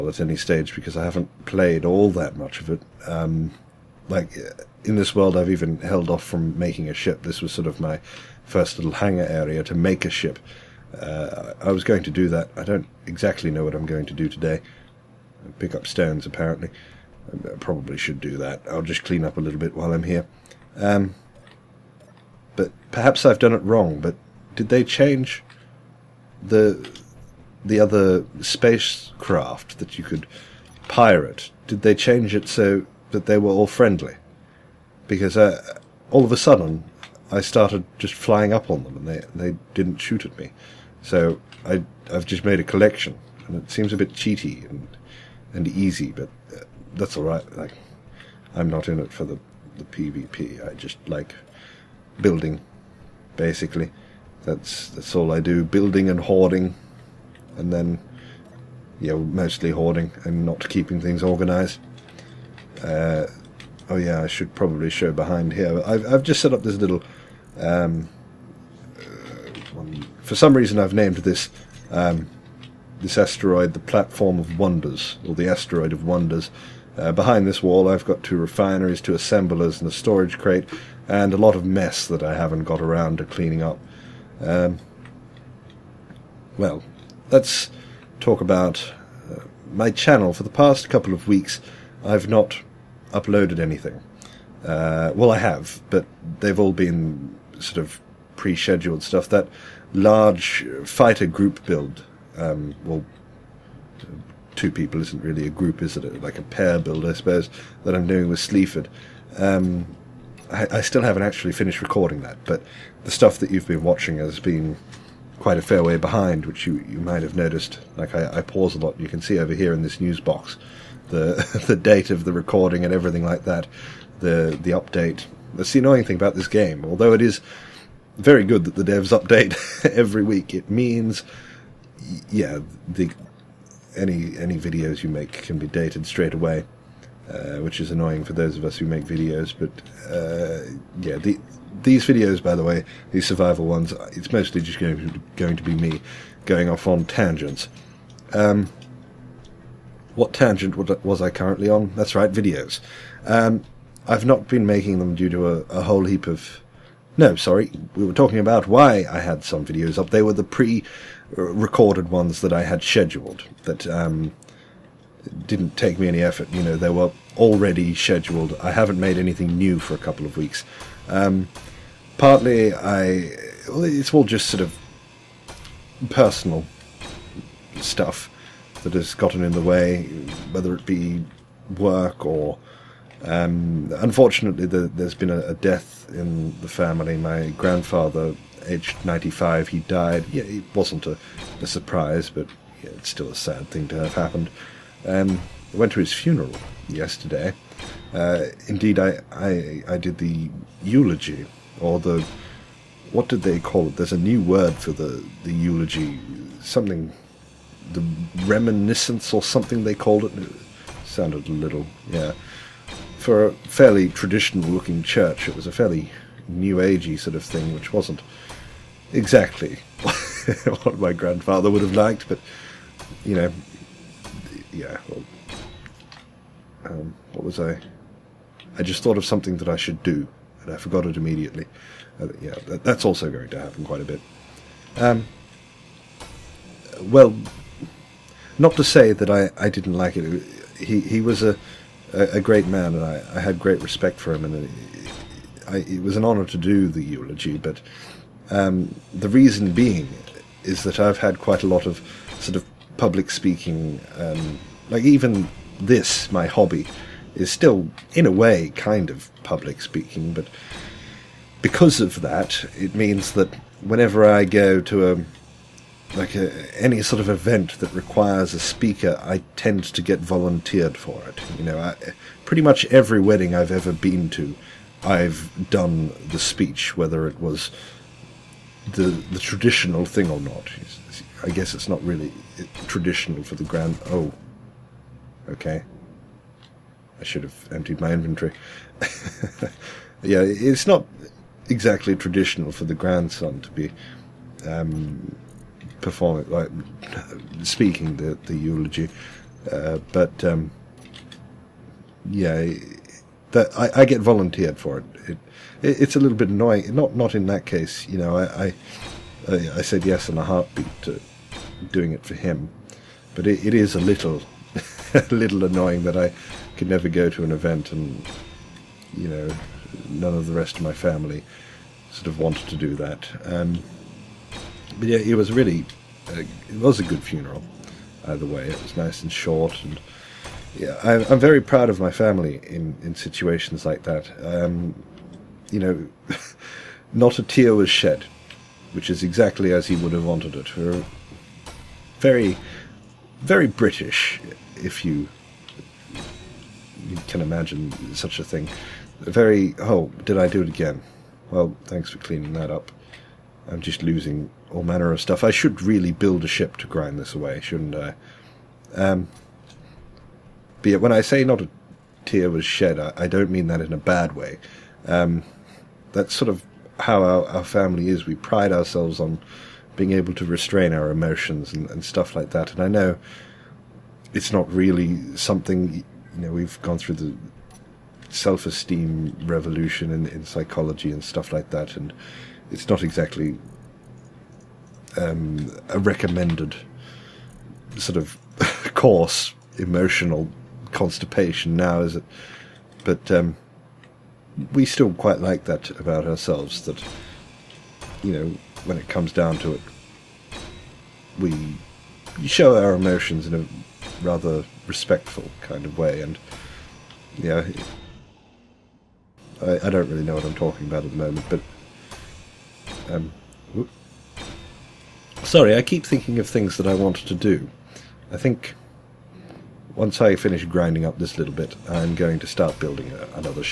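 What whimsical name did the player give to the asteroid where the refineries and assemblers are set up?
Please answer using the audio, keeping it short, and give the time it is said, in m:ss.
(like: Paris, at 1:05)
Platform of Wonders, at 1:13.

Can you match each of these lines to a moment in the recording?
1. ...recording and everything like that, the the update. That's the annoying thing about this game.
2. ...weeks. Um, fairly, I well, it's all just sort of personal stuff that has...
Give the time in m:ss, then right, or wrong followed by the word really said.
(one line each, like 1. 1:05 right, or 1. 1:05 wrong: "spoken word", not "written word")
1. 2:02 right
2. 2:50 wrong: "partly", not "fairly".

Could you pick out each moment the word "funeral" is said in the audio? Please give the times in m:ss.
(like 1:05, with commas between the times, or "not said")
3:16, 5:27.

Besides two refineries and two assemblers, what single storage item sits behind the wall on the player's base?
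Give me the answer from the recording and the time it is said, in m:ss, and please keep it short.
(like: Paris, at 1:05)
a storage crate, at 1:19.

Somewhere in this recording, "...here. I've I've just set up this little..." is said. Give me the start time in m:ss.
1:05.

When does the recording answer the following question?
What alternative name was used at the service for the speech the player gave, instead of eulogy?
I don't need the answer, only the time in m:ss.
3:28.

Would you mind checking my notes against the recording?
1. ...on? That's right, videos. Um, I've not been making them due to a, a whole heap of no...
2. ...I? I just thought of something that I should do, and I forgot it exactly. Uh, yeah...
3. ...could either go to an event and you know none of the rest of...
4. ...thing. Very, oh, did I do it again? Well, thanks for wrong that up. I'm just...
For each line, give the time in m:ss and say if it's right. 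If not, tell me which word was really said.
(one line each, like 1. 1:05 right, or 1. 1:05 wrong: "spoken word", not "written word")
1. 2:31 right
2. 3:47 wrong: "immediately", not "exactly"
3. 5:16 wrong: "never", not "either"
4. 5:48 wrong: "cleaning", not "wrong".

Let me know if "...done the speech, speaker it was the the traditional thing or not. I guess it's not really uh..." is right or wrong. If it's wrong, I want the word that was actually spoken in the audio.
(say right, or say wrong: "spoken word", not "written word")
wrong: "whether", not "speaker".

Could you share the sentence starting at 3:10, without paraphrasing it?
Yeah, it wasn't a, a surprise, but yeah, it's still a sad thing to have happened.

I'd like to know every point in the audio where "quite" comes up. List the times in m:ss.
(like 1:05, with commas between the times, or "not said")
1:55, 3:53, 4:11, 6:35.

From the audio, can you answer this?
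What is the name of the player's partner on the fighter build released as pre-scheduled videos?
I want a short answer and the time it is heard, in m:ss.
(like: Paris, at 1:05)
Sleaford, at 1:48.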